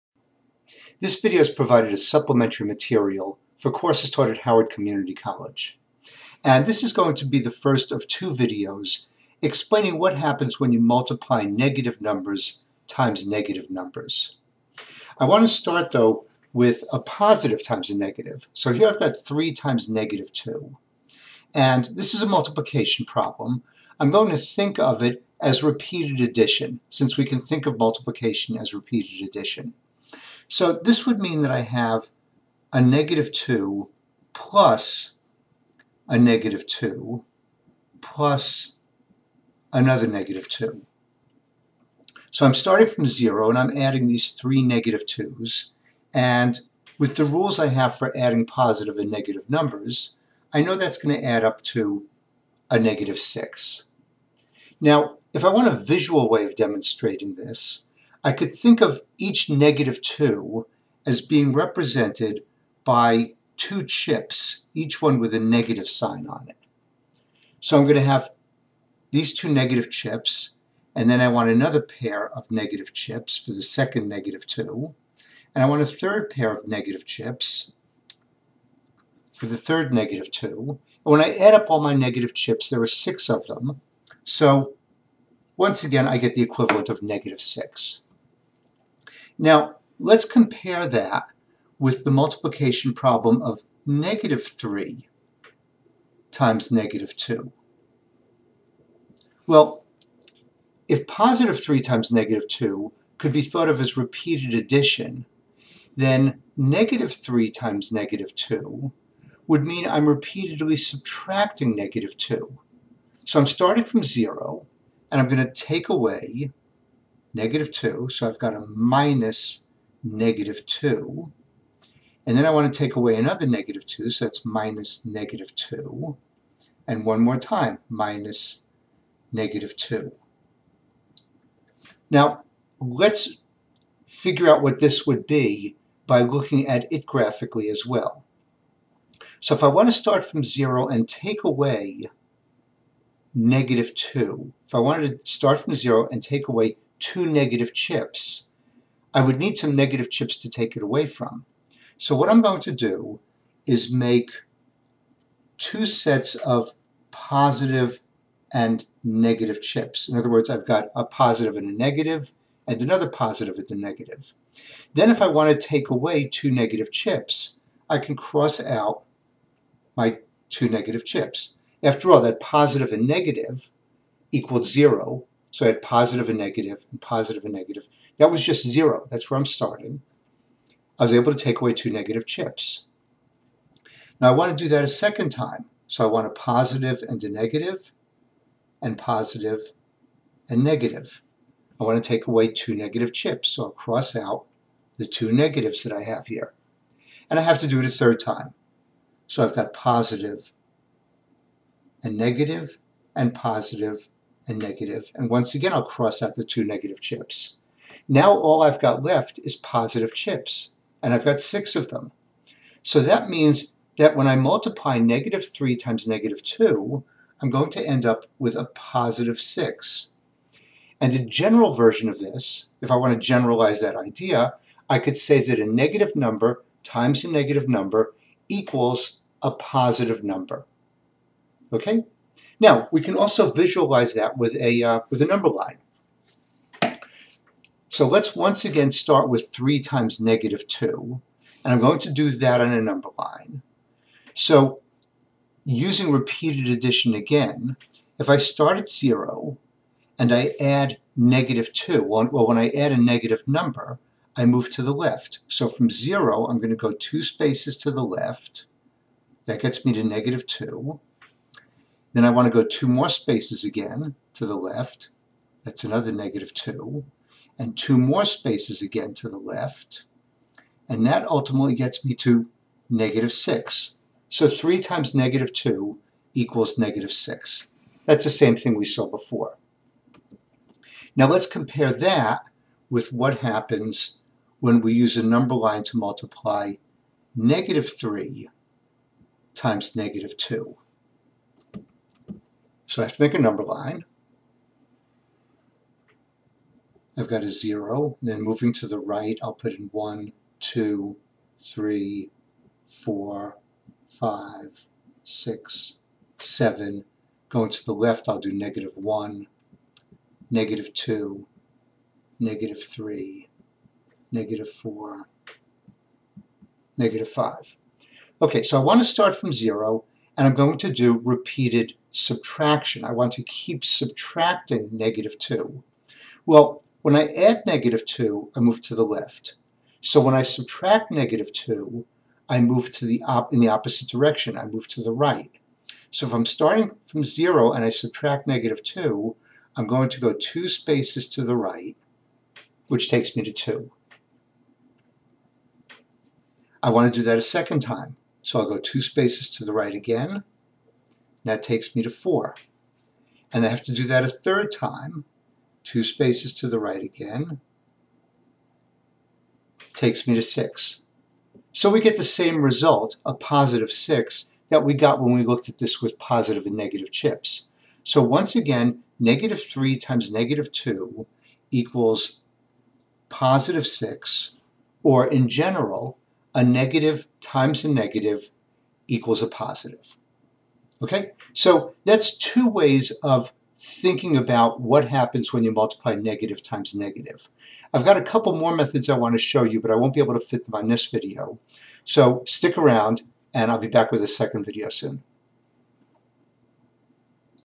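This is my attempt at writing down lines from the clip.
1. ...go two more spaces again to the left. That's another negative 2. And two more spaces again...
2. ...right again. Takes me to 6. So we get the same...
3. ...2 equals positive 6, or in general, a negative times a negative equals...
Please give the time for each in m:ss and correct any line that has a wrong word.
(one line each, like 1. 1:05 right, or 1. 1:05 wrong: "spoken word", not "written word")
1. 4:22 right
2. 5:56 right
3. 6:10 right.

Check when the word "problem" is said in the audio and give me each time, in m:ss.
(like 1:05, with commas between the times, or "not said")
0:23, 1:32.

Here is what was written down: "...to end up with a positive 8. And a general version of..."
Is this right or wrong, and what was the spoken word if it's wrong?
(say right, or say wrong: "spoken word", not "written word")
wrong: "6", not "8".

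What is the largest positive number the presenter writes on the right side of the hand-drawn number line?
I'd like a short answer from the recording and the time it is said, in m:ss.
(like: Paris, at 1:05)
7, at 5:06.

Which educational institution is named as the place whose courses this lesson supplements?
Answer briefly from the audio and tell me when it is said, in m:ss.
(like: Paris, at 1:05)
Howard Community College, at 0:04.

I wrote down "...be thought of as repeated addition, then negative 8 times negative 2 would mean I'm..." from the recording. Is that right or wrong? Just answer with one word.
wrong.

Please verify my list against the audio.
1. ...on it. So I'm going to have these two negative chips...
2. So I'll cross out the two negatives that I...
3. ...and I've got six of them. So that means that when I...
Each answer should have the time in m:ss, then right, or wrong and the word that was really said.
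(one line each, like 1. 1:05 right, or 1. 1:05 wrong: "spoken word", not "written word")
1. 1:06 right
2. 3:13 right
3. 3:31 right.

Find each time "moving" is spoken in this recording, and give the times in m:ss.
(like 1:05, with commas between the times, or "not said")
4:58.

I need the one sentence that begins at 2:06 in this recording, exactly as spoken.
And one more time, minus negative 2.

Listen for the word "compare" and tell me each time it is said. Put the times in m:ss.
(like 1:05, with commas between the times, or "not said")
1:30, 4:41.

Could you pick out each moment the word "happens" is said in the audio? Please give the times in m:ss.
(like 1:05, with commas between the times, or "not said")
0:10, 4:43, 6:25.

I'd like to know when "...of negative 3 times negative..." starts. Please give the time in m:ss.
1:33.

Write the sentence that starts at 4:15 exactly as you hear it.
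So from 0, I'm going to go two spaces to the left.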